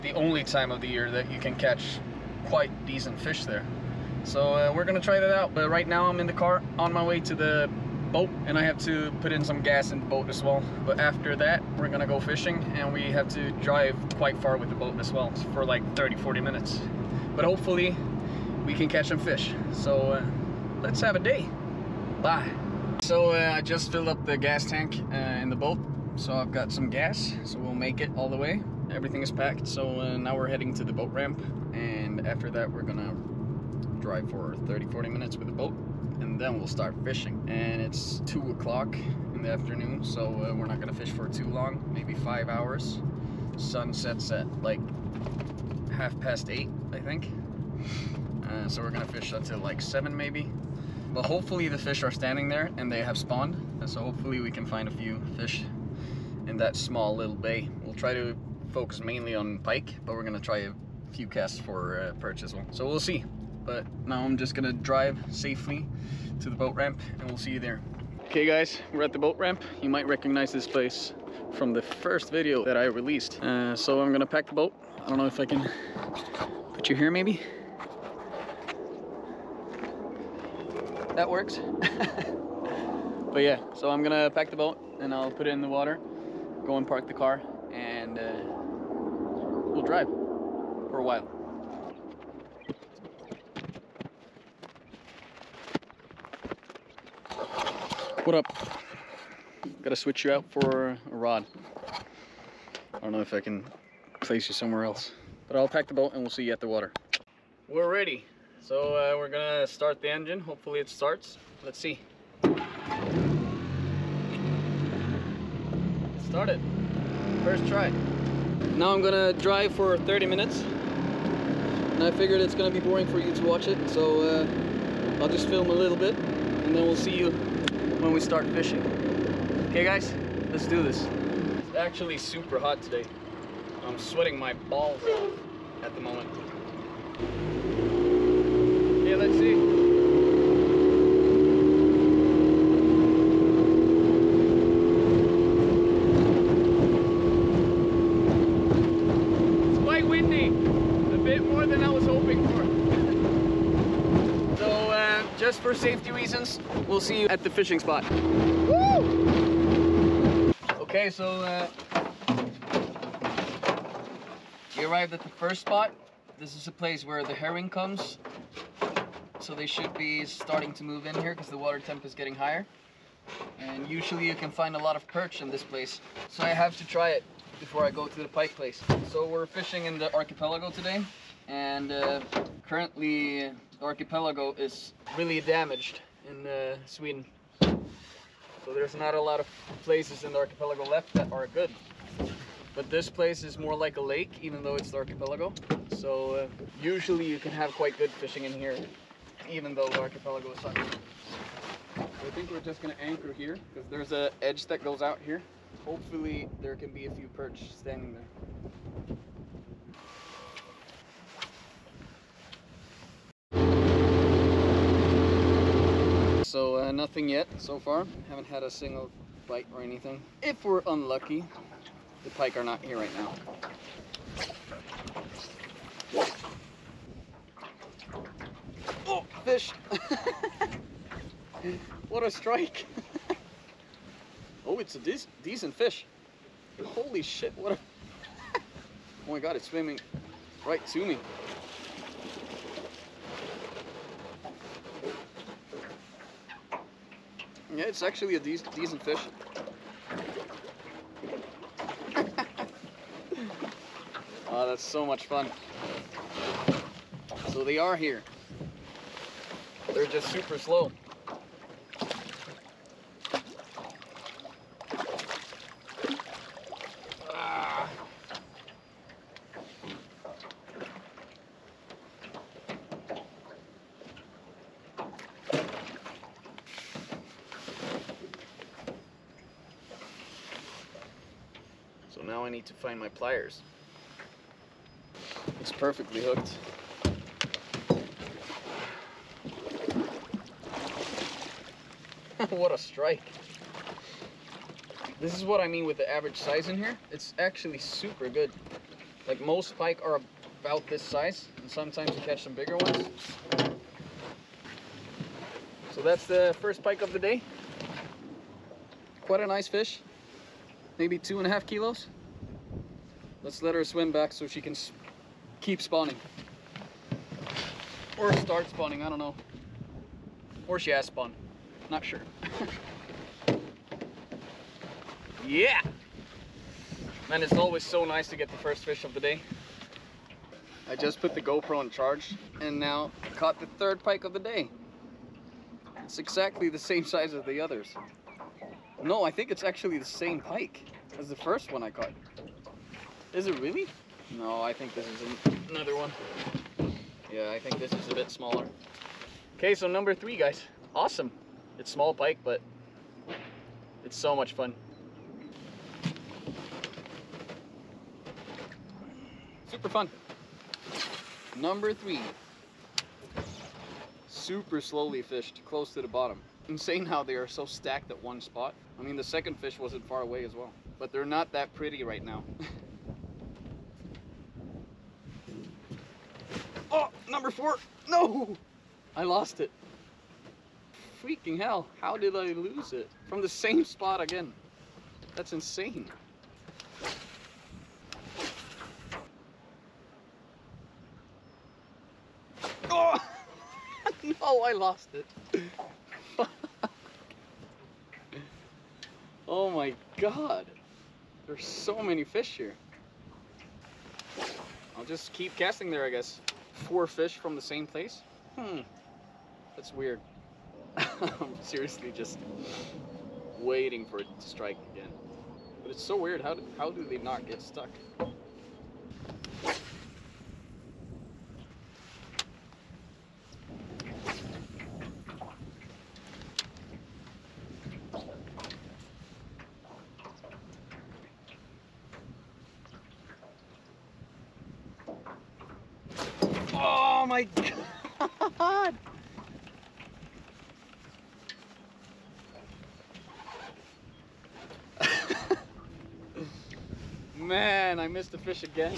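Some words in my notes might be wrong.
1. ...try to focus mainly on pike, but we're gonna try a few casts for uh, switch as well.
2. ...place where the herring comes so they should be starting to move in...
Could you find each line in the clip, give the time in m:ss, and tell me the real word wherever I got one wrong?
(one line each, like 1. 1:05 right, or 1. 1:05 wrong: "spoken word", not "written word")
1. 0:57 wrong: "perch", not "switch"
2. 2:46 right.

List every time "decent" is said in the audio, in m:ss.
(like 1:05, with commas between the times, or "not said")
0:02, 3:55, 4:08.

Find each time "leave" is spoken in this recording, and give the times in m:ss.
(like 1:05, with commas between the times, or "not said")
not said.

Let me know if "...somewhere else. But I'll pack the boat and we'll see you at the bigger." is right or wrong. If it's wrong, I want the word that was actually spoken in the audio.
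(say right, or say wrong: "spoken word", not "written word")
wrong: "water", not "bigger".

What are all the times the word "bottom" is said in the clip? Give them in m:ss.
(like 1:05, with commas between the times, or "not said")
6:06.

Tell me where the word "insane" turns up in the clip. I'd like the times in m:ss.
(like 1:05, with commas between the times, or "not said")
6:06, 6:25.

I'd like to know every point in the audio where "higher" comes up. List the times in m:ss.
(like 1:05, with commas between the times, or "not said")
2:52.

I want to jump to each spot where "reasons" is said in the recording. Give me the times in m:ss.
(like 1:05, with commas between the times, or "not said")
2:36.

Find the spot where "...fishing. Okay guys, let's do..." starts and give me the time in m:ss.
2:08.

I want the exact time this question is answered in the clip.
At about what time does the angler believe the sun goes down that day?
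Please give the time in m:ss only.
0:45.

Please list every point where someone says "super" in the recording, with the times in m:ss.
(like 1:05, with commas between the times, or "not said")
2:12, 4:20, 4:57, 5:59, 6:04.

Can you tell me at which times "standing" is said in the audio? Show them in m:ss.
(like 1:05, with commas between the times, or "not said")
0:52, 3:27.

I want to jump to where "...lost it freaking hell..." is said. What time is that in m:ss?
6:19.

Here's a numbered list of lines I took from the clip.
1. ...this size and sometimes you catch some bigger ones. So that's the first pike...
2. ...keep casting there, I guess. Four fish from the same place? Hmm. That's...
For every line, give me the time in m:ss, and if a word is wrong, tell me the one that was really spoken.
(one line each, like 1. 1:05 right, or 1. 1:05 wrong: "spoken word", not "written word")
1. 5:00 right
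2. 6:45 right.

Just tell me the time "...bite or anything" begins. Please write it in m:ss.
3:39.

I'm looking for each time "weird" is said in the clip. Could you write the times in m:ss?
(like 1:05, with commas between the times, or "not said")
6:49, 6:56.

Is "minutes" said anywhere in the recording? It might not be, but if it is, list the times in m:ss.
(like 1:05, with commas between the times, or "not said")
0:16, 0:35, 2:00.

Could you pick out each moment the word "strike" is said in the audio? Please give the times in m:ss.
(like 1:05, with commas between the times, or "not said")
3:52, 4:52, 6:54.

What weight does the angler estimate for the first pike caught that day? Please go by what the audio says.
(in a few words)
2.5 kilos.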